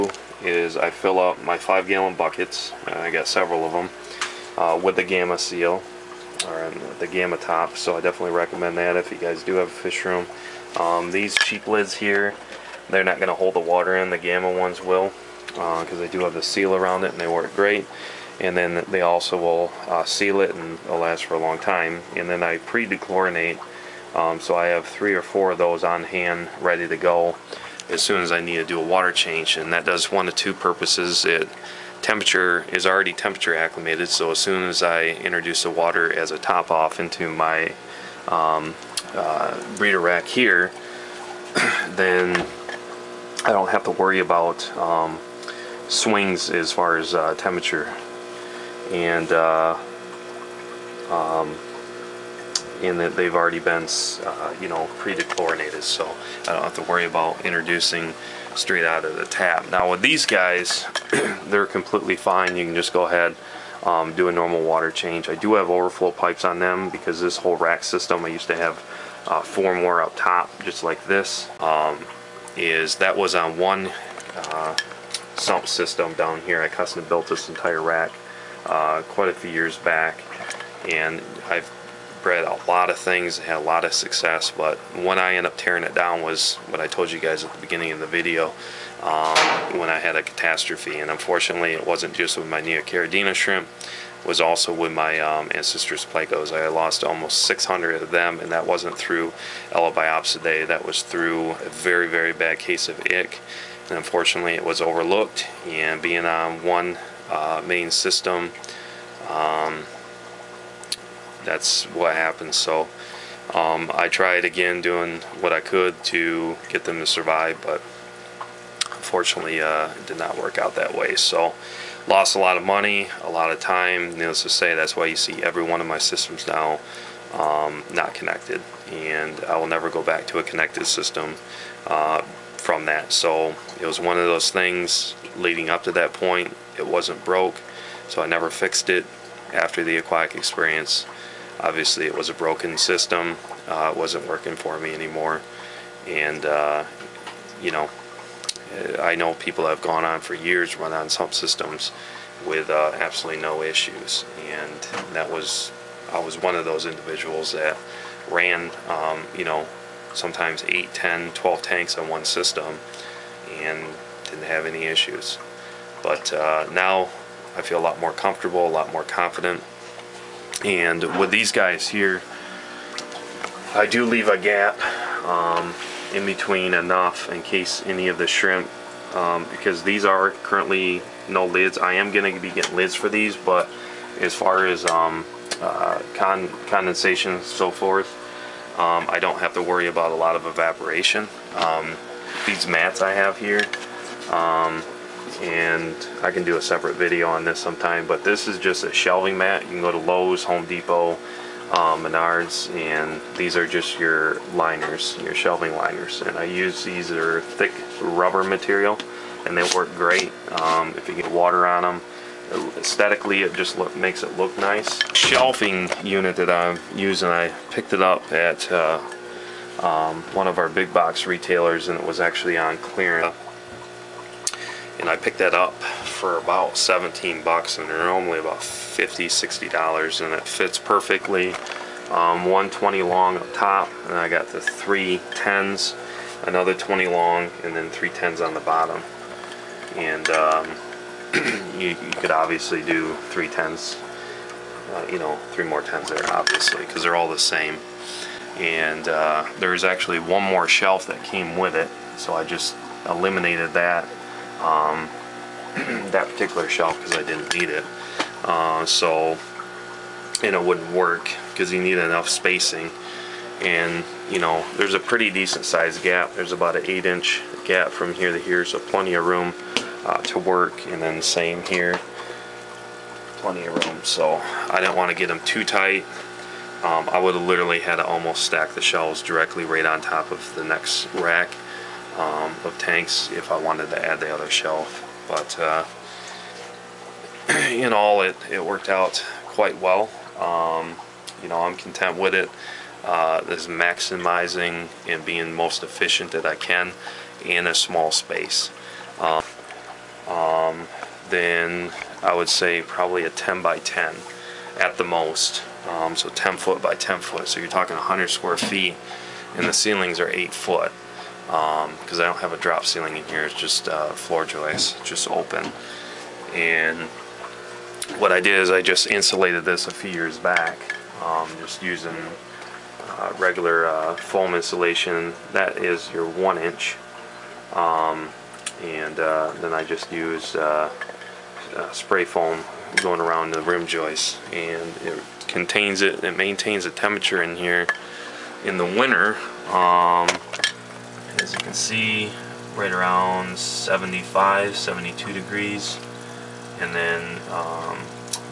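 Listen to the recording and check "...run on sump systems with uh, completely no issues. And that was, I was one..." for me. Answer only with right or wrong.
wrong.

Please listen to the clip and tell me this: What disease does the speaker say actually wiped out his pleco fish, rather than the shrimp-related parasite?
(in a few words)
Ick.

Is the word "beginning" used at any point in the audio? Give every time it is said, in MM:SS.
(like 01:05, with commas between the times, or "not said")
01:27.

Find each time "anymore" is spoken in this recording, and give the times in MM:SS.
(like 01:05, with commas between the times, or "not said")
02:24.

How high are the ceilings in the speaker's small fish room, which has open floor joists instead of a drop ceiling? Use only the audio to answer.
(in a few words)
8 feet.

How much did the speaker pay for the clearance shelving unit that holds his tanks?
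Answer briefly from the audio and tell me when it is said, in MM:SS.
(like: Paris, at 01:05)
$17, at 03:46.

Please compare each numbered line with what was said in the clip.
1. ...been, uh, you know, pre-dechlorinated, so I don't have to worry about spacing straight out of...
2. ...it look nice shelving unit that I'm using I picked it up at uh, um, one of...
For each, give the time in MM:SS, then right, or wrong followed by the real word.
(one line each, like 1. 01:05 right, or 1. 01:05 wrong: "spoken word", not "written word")
1. 00:53 wrong: "introducing", not "spacing"
2. 03:34 right.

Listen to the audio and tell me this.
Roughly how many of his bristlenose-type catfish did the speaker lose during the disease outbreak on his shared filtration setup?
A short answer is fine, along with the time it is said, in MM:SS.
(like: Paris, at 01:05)
600, at 01:37.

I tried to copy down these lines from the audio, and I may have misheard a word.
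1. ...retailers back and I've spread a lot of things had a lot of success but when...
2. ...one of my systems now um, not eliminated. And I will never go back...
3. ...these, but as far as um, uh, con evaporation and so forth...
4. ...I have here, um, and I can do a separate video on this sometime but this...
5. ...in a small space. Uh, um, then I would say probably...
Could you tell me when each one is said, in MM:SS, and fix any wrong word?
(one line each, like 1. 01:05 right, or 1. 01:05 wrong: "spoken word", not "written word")
1. 01:19 wrong: "years", not "retailers"
2. 02:05 wrong: "connected", not "eliminated"
3. 03:03 wrong: "condensation", not "evaporation"
4. 03:13 right
5. 04:57 right.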